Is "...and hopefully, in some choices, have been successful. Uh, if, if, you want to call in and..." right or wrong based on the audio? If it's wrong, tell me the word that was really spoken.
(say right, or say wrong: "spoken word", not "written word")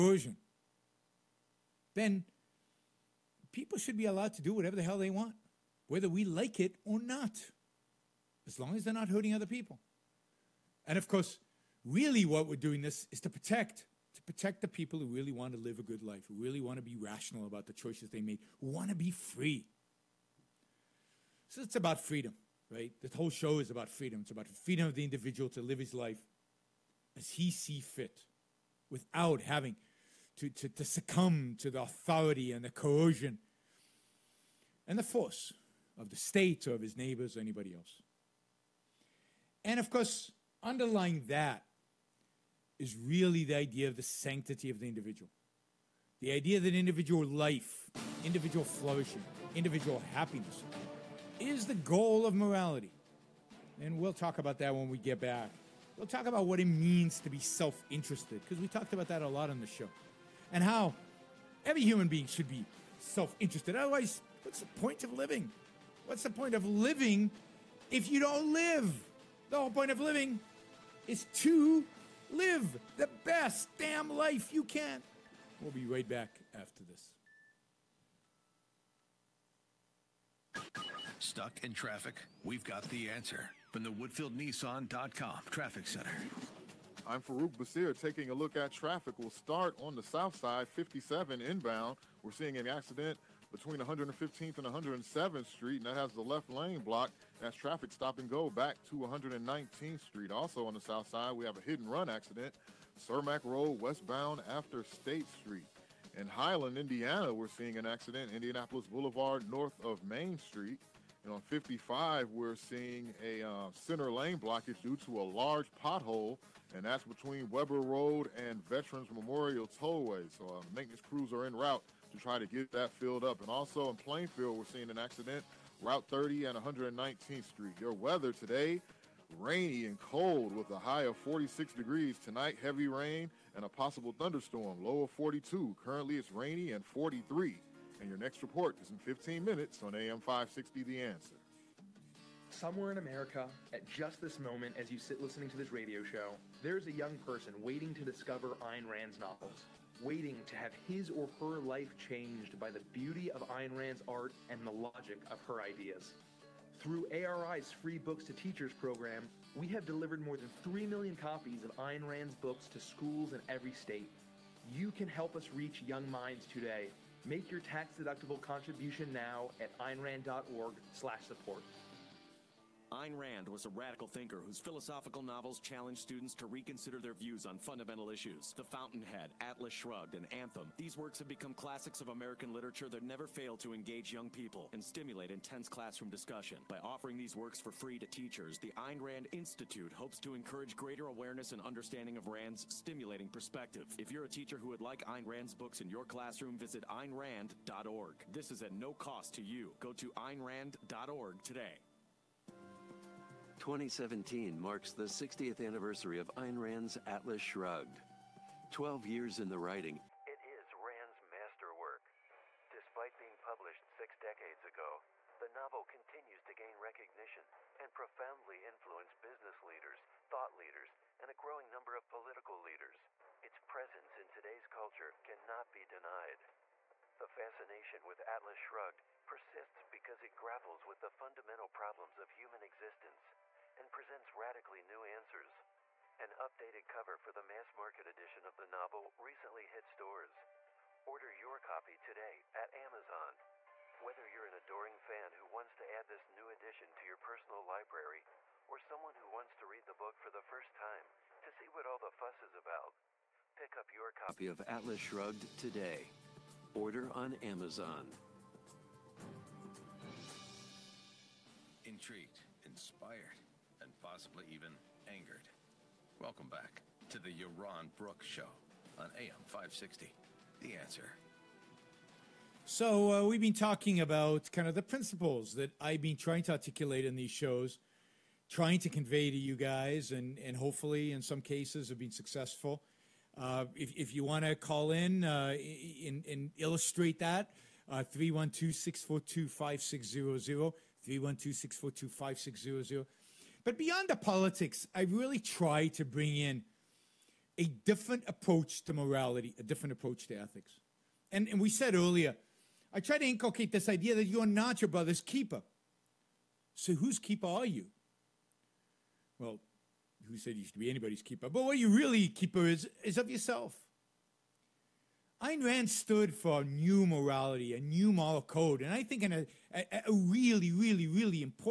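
wrong: "cases", not "choices".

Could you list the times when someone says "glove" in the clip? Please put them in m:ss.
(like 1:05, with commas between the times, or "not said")
not said.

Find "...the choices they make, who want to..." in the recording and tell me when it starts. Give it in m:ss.
0:17.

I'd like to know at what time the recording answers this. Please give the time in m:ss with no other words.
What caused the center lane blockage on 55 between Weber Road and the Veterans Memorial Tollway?
1:55.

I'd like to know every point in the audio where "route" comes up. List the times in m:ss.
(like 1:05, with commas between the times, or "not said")
2:01, 2:05.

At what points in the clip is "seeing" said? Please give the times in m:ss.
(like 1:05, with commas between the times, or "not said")
1:32, 1:47, 1:52, 2:04.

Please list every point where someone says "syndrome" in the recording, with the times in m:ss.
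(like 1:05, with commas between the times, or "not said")
not said.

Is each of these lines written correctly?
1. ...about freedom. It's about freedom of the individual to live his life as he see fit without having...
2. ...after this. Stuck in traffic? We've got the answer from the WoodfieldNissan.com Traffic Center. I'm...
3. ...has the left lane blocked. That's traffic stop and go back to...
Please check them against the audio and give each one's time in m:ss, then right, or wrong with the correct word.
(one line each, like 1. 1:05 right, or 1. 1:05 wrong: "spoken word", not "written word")
1. 0:23 right
2. 1:16 right
3. 1:35 right.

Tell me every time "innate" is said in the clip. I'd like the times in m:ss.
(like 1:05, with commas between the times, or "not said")
not said.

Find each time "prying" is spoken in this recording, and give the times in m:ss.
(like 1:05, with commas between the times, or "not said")
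not said.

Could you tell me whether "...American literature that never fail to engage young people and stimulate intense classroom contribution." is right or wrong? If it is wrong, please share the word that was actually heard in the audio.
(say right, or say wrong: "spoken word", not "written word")
wrong: "discussion", not "contribution".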